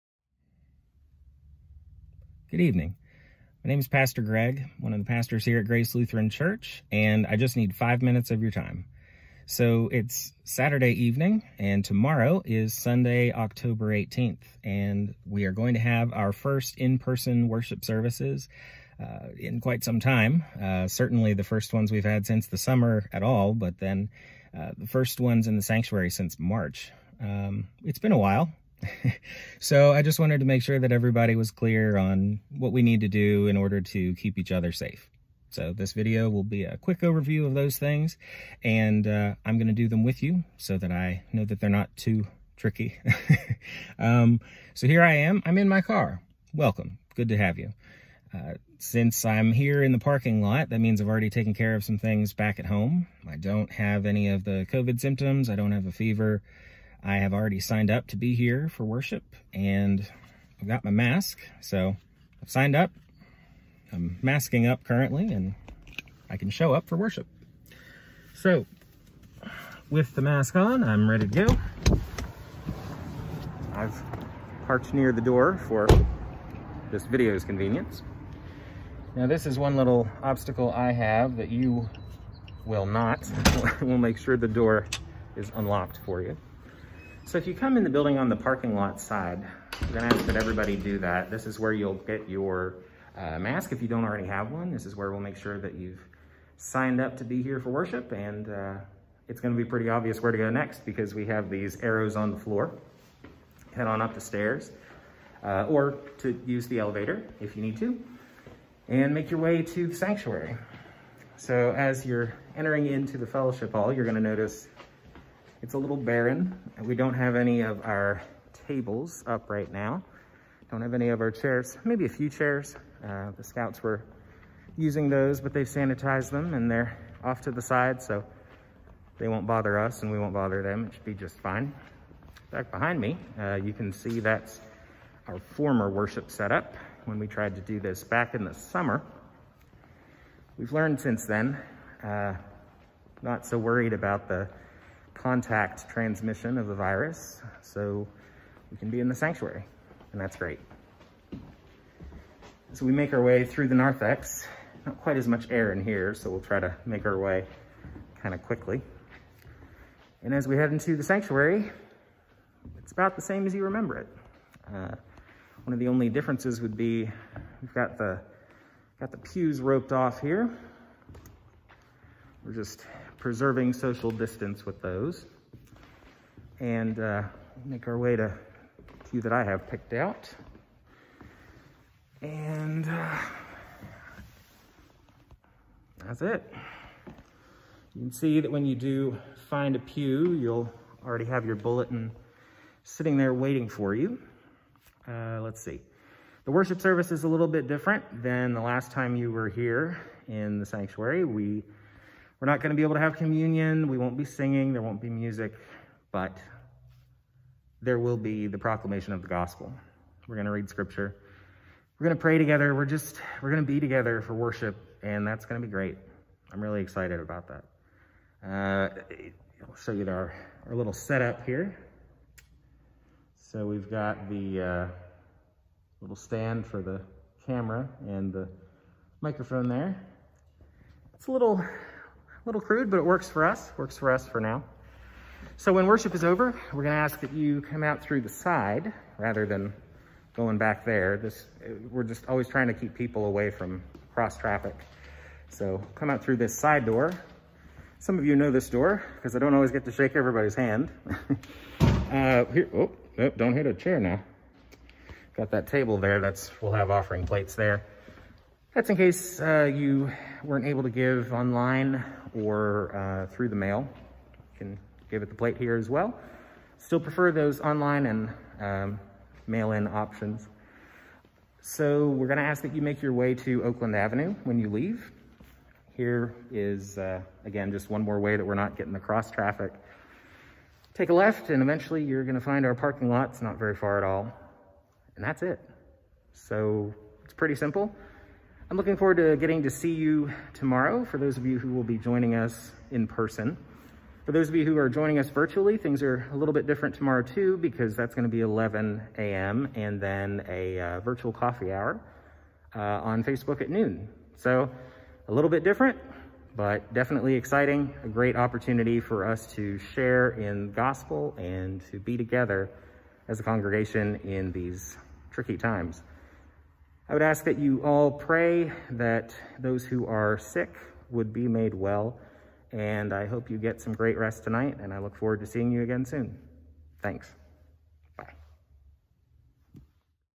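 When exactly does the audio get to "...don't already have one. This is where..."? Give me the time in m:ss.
1:33.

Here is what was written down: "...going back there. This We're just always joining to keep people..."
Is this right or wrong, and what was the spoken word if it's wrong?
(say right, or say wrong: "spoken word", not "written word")
wrong: "trying", not "joining".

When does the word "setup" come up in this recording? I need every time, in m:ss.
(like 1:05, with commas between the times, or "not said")
2:16, 3:40.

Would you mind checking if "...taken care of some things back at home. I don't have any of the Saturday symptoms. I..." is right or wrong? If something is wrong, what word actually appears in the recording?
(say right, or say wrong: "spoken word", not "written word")
wrong: "COVID", not "Saturday".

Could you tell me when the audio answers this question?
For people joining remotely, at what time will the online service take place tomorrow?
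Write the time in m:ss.
4:58.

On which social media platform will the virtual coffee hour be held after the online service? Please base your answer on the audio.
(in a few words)
Facebook.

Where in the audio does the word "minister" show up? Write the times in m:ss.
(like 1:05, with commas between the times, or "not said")
not said.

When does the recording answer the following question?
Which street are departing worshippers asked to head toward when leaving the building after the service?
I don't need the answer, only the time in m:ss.
4:33.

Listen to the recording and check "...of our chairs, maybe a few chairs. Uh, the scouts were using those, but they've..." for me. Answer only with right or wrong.
right.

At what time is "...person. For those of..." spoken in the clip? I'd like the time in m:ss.
4:53.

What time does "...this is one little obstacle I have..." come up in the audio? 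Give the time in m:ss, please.
1:19.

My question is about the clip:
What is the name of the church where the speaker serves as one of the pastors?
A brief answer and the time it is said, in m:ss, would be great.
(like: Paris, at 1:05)
Grace Lutheran Church, at 0:05.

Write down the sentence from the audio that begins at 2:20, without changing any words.
We've learned since then, uh, not so worried about the contact transmission of the virus.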